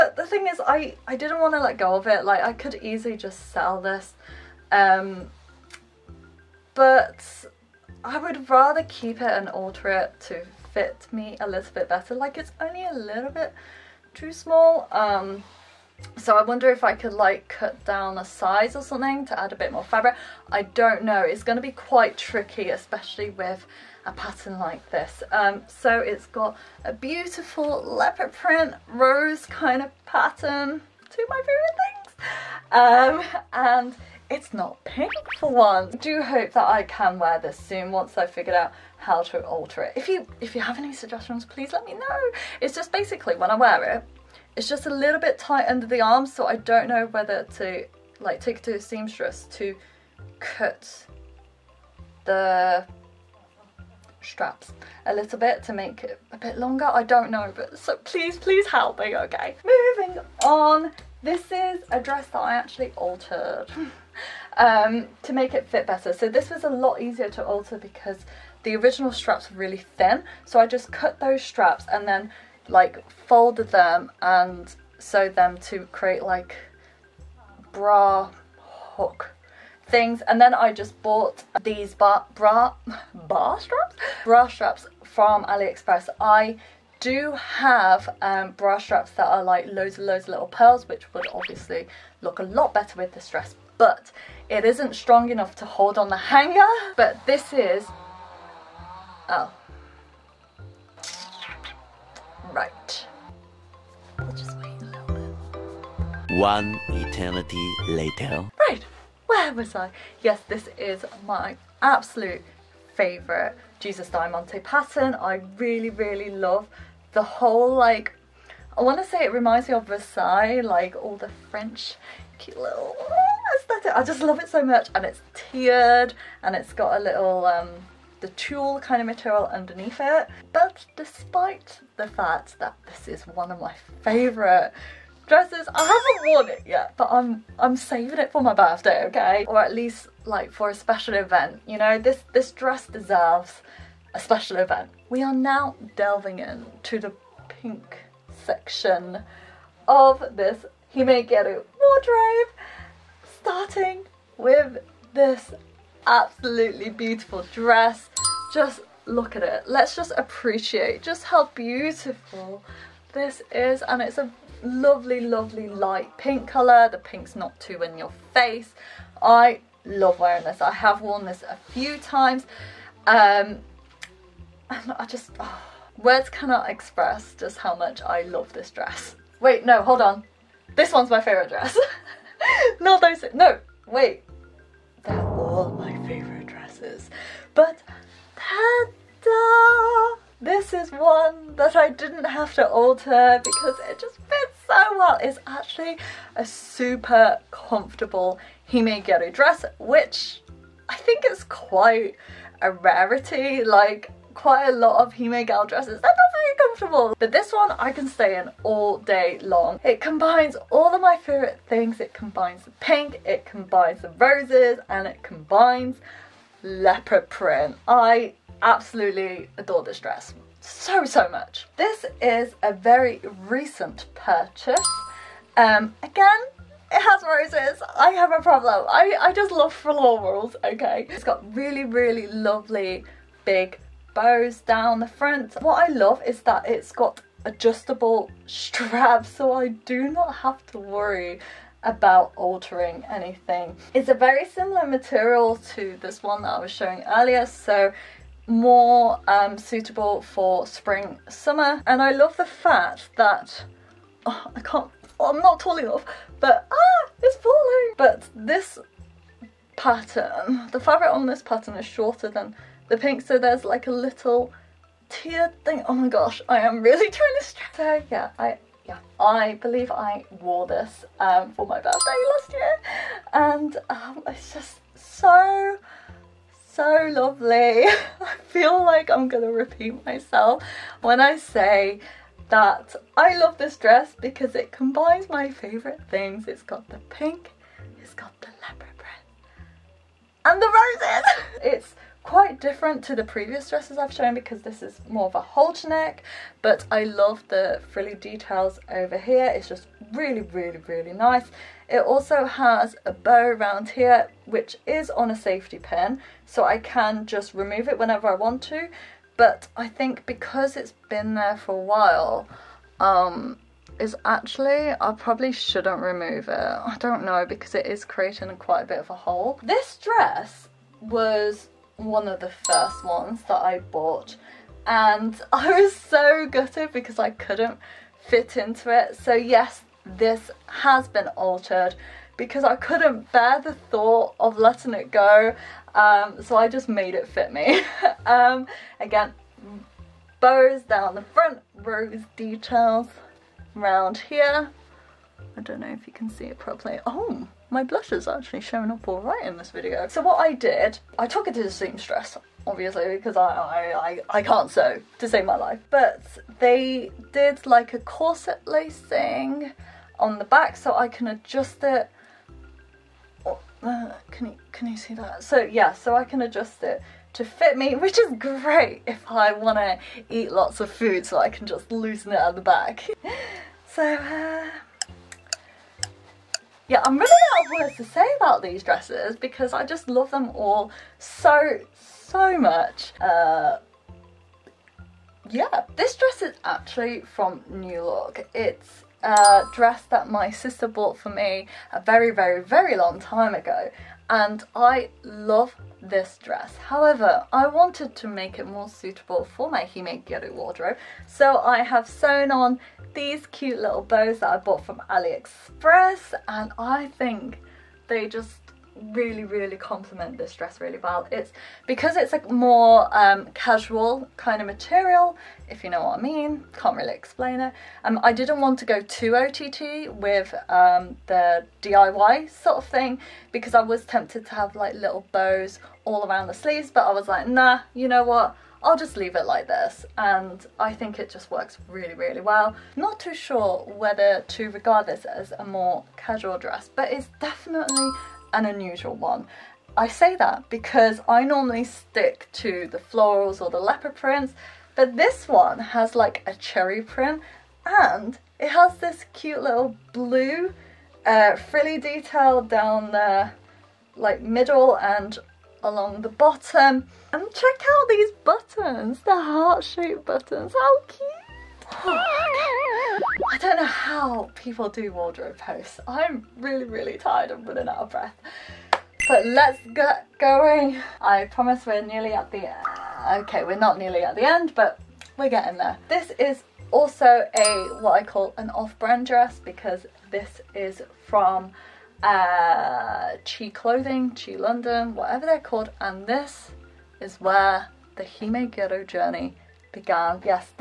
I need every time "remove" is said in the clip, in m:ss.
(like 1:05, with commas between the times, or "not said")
5:07, 5:16.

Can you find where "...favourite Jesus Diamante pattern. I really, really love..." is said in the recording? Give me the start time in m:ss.
1:52.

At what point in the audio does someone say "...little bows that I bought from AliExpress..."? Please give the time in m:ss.
6:43.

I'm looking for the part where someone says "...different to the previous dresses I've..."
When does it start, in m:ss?
4:52.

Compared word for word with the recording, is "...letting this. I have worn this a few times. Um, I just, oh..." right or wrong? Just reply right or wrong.
wrong.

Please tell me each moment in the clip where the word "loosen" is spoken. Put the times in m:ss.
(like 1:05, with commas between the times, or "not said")
6:11.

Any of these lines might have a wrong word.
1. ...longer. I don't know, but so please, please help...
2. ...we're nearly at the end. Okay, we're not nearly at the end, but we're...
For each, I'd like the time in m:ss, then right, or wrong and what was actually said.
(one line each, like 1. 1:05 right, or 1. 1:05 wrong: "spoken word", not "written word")
1. 0:56 right
2. 7:51 right.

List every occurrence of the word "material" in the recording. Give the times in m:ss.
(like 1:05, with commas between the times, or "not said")
2:09, 4:04, 6:54.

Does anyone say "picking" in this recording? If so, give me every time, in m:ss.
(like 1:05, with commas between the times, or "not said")
not said.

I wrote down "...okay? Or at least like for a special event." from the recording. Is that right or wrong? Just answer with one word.
right.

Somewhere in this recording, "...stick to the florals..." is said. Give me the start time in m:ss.
7:21.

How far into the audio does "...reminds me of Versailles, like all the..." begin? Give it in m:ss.
1:59.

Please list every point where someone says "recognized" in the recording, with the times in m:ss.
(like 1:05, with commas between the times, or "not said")
not said.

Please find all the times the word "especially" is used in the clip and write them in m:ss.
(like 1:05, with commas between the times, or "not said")
0:22.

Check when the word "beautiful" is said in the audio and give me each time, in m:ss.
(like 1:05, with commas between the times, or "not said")
0:26, 2:36, 2:41.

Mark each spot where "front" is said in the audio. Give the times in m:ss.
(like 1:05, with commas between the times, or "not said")
3:55, 5:41.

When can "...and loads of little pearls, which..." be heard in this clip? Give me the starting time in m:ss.
1:29.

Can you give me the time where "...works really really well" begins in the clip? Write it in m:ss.
7:11.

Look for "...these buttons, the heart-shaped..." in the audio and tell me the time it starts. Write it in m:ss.
7:38.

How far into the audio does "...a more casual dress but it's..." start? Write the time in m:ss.
7:15.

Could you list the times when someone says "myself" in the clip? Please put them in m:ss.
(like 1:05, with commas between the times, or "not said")
4:40.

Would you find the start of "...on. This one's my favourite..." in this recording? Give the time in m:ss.
3:00.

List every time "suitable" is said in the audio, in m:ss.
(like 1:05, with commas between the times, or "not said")
4:09, 6:38.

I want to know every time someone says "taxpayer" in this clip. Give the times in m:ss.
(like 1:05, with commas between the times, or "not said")
not said.